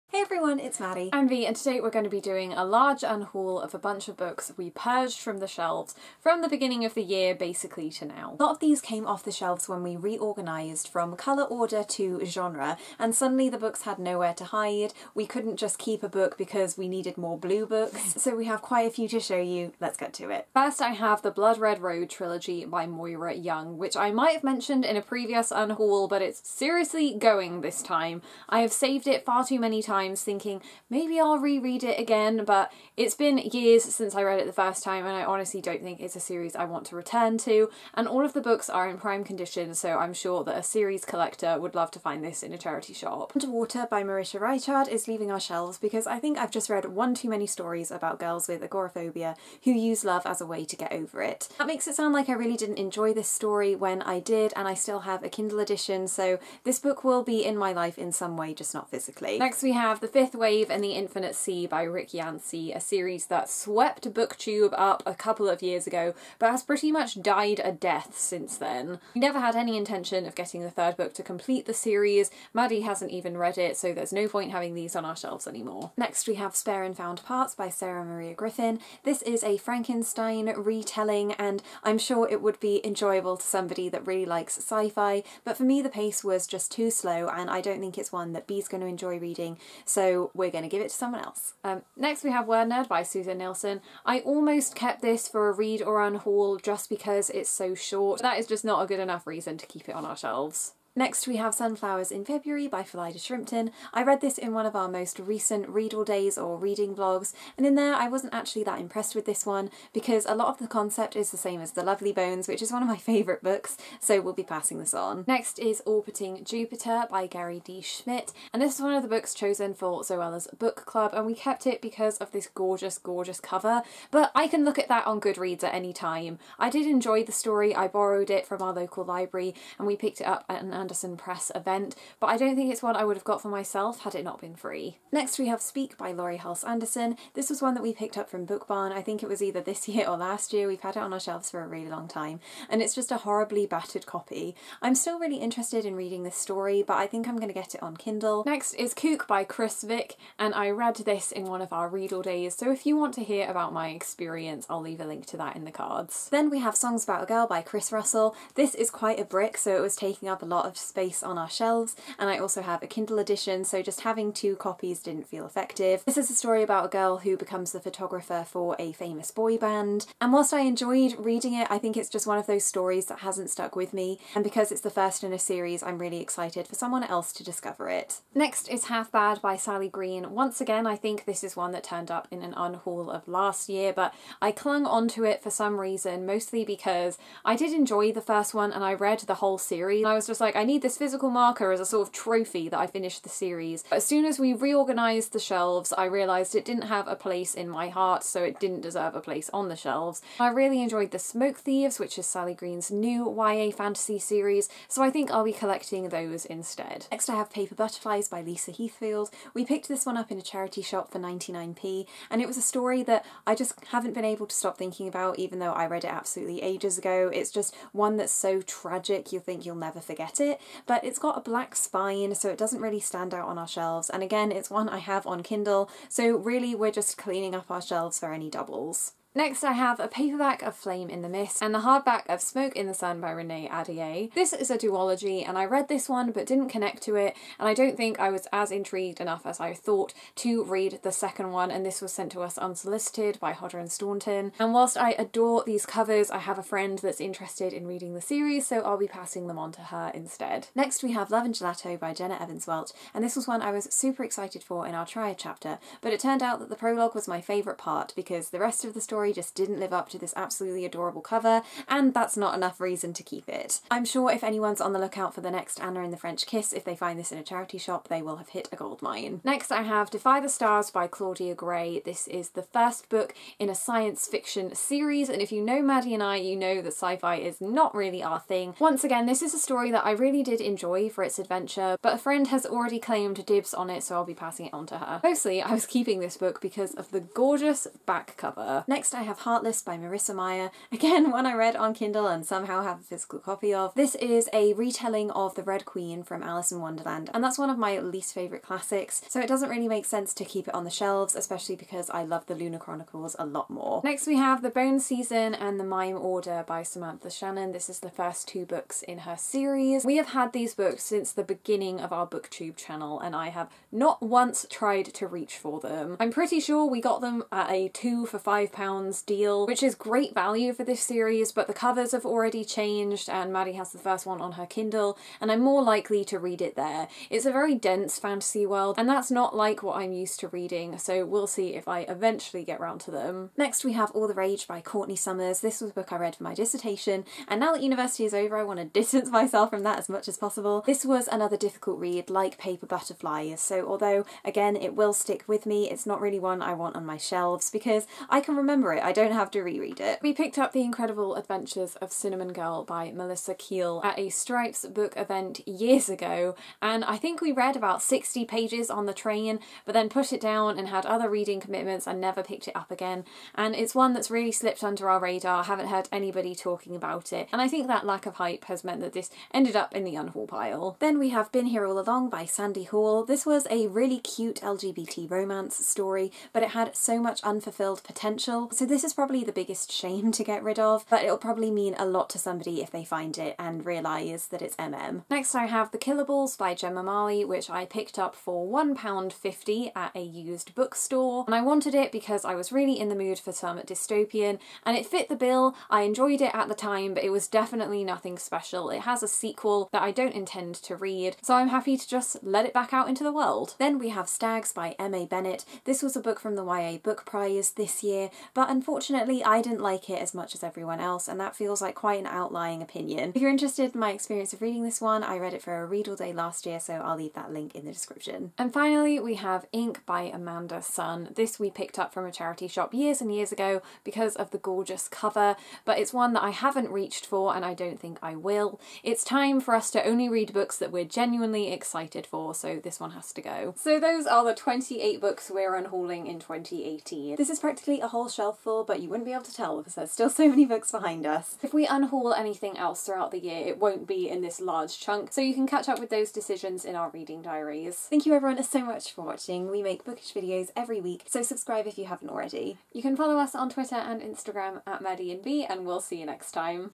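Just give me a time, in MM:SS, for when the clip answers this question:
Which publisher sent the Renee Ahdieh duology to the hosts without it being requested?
04:03.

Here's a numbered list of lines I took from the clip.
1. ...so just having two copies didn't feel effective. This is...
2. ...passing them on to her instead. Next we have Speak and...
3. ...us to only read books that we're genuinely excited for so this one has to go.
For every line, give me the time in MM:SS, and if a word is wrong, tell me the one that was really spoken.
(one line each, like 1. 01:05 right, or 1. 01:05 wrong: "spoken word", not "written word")
1. 02:43 right
2. 04:09 wrong: "Love", not "Speak"
3. 07:09 right.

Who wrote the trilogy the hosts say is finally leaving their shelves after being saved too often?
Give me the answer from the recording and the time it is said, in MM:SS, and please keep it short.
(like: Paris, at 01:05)
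Moira Young, at 00:22.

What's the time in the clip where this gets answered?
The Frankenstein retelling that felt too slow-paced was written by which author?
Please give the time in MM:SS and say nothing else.
01:17.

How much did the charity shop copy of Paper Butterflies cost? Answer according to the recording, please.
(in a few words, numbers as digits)
99p.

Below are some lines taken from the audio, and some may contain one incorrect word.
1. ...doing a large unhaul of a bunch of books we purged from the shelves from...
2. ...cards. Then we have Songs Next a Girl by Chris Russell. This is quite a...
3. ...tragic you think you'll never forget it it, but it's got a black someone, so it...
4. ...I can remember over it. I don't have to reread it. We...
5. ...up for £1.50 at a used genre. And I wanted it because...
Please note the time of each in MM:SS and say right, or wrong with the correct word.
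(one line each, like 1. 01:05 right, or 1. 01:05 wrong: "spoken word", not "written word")
1. 00:02 right
2. 02:35 wrong: "About", not "Next"
3. 03:38 wrong: "spine", not "someone"
4. 05:48 right
5. 06:28 wrong: "bookstore", not "genre".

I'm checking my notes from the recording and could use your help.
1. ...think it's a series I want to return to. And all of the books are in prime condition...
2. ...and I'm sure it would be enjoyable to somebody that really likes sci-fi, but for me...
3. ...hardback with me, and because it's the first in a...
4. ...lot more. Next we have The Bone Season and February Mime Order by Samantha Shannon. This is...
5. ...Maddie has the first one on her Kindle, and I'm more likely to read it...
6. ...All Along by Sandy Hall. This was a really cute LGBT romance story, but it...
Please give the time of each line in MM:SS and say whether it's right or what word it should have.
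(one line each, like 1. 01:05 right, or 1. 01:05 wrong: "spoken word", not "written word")
1. 00:35 right
2. 01:21 right
3. 02:53 wrong: "stuck", not "hardback"
4. 05:03 wrong: "The", not "February"
5. 05:23 right
6. 06:11 right.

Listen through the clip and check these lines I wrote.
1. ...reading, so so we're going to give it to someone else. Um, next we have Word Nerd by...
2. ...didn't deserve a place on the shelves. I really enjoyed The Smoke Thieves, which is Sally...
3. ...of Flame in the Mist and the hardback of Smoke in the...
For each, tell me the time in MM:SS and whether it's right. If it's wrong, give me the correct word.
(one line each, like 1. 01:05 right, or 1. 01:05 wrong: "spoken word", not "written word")
1. 01:29 right
2. 03:18 right
3. 03:50 right.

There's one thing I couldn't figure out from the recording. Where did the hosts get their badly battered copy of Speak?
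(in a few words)
Book Barn.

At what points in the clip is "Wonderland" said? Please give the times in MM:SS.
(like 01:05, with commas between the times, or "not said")
04:56.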